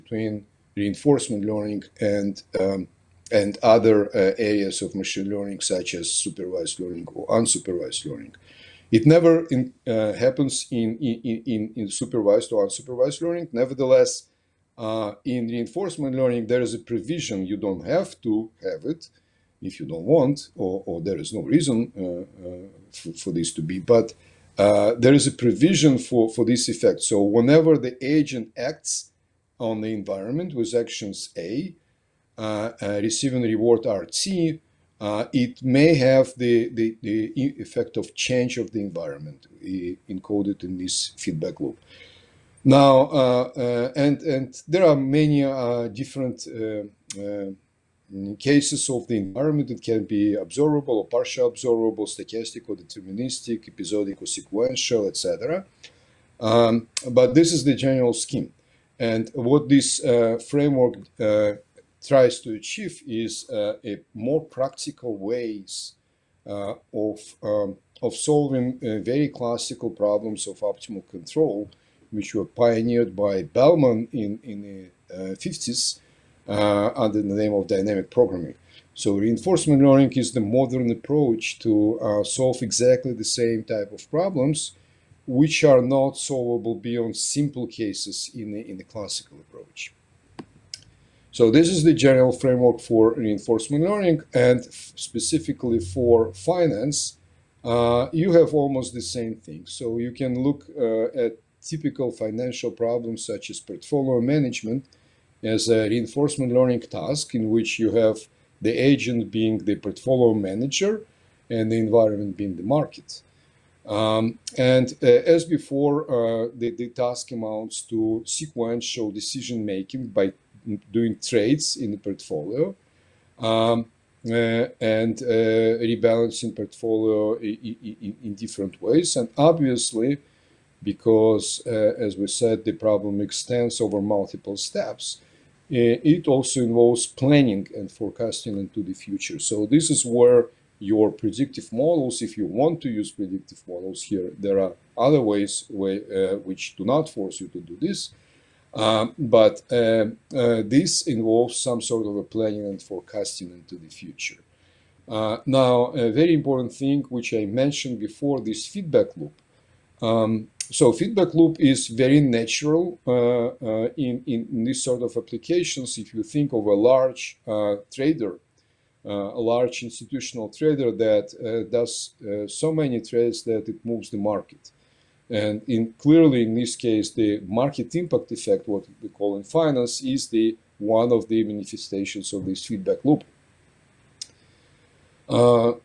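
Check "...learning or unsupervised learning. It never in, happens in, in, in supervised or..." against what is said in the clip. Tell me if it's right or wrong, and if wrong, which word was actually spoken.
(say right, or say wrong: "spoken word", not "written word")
right.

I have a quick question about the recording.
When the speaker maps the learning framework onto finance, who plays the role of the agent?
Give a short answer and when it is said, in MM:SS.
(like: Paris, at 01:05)
the portfolio manager, at 01:49.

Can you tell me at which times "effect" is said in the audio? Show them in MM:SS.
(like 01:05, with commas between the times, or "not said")
00:26, 00:37, 02:58.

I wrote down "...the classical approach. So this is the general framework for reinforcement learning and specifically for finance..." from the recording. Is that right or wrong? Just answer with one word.
right.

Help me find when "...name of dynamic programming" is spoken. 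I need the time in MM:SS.
01:17.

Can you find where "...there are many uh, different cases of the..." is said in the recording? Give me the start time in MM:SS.
00:44.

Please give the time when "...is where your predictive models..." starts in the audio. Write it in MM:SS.
02:19.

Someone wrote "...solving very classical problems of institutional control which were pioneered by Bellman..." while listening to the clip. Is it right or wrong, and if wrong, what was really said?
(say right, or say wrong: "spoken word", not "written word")
wrong: "optimal", not "institutional".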